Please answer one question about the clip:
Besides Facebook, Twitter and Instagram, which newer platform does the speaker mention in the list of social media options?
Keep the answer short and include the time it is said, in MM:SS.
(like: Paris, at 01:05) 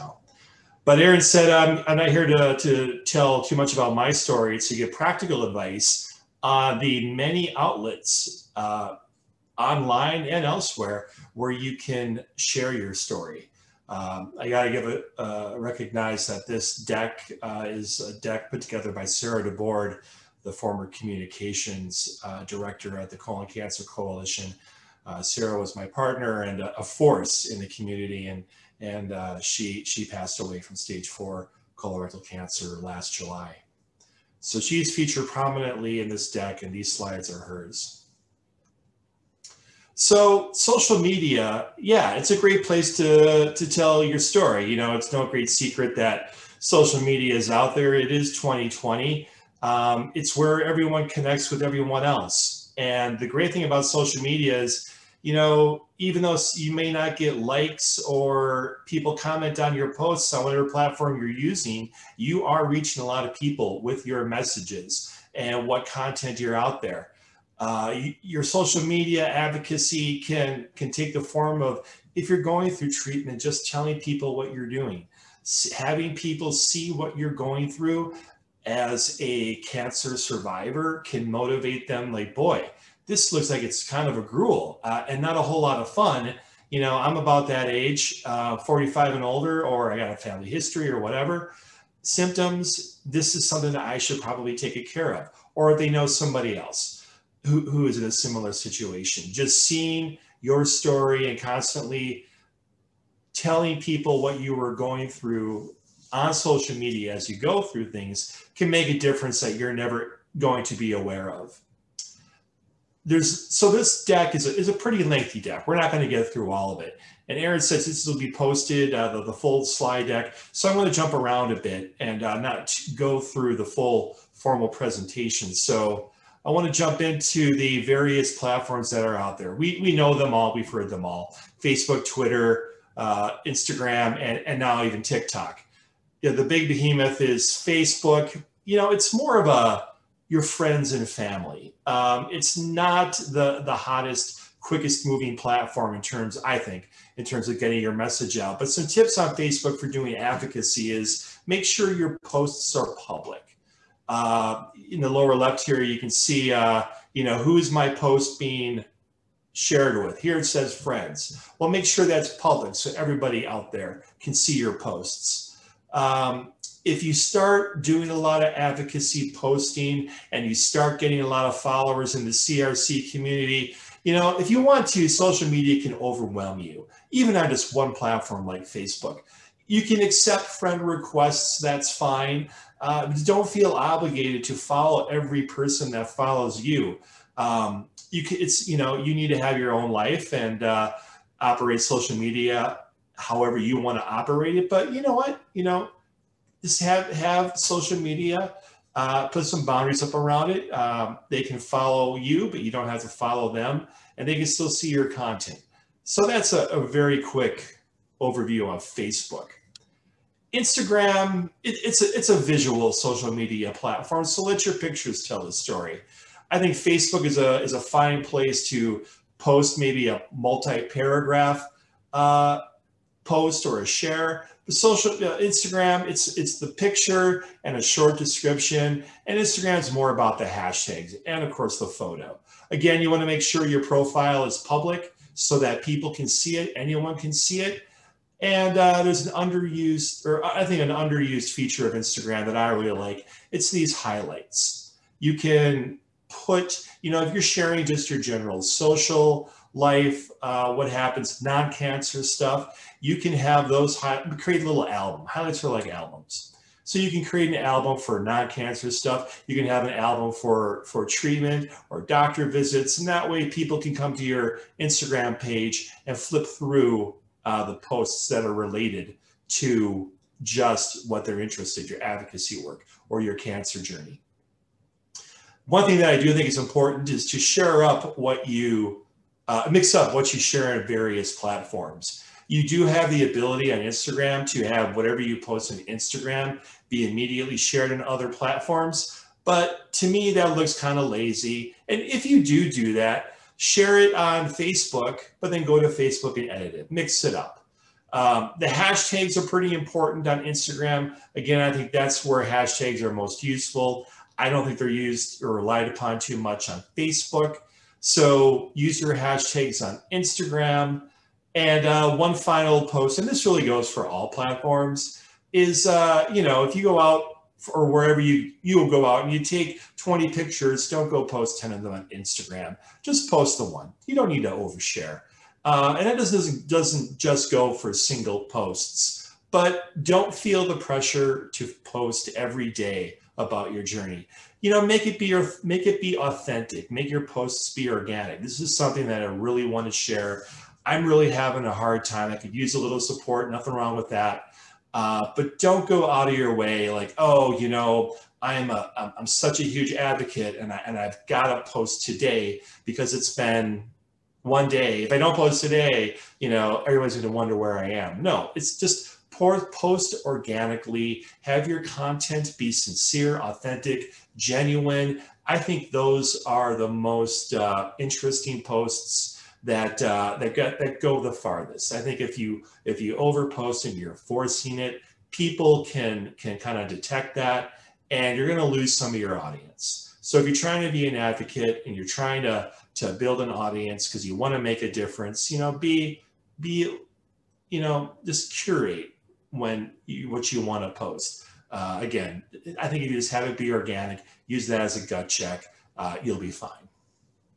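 TikTok, at 02:15.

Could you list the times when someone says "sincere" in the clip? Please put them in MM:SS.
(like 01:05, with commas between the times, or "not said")
06:02.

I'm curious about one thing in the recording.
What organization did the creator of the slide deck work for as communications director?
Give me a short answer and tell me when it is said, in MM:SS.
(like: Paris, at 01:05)
Colon Cancer Coalition, at 00:23.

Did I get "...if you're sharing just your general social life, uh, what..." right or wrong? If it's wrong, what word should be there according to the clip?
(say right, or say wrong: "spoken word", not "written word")
right.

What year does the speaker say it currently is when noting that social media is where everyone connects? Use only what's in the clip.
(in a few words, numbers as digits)
2020.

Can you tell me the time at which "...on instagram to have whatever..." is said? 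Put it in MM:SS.
04:43.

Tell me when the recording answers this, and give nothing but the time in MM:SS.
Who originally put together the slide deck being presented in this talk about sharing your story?
00:19.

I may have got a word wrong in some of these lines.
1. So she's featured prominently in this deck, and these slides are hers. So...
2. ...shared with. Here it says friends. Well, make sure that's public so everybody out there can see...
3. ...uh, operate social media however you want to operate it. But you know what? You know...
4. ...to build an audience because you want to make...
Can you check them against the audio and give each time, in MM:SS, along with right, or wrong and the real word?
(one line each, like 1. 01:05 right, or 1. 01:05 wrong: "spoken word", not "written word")
1. 00:34 right
2. 02:39 right
3. 03:10 right
4. 06:22 right.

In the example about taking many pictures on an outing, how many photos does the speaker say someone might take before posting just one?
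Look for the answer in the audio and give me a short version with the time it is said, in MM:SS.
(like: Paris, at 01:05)
20, at 05:19.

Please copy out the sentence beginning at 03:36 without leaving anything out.
I think Facebook is a, is a fine place to post maybe a multi-paragraph uh, post or a share.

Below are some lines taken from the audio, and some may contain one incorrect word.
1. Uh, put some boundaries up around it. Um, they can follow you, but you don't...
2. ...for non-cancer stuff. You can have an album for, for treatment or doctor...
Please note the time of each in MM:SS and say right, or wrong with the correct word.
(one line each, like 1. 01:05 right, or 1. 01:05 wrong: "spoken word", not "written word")
1. 03:18 right
2. 04:17 right.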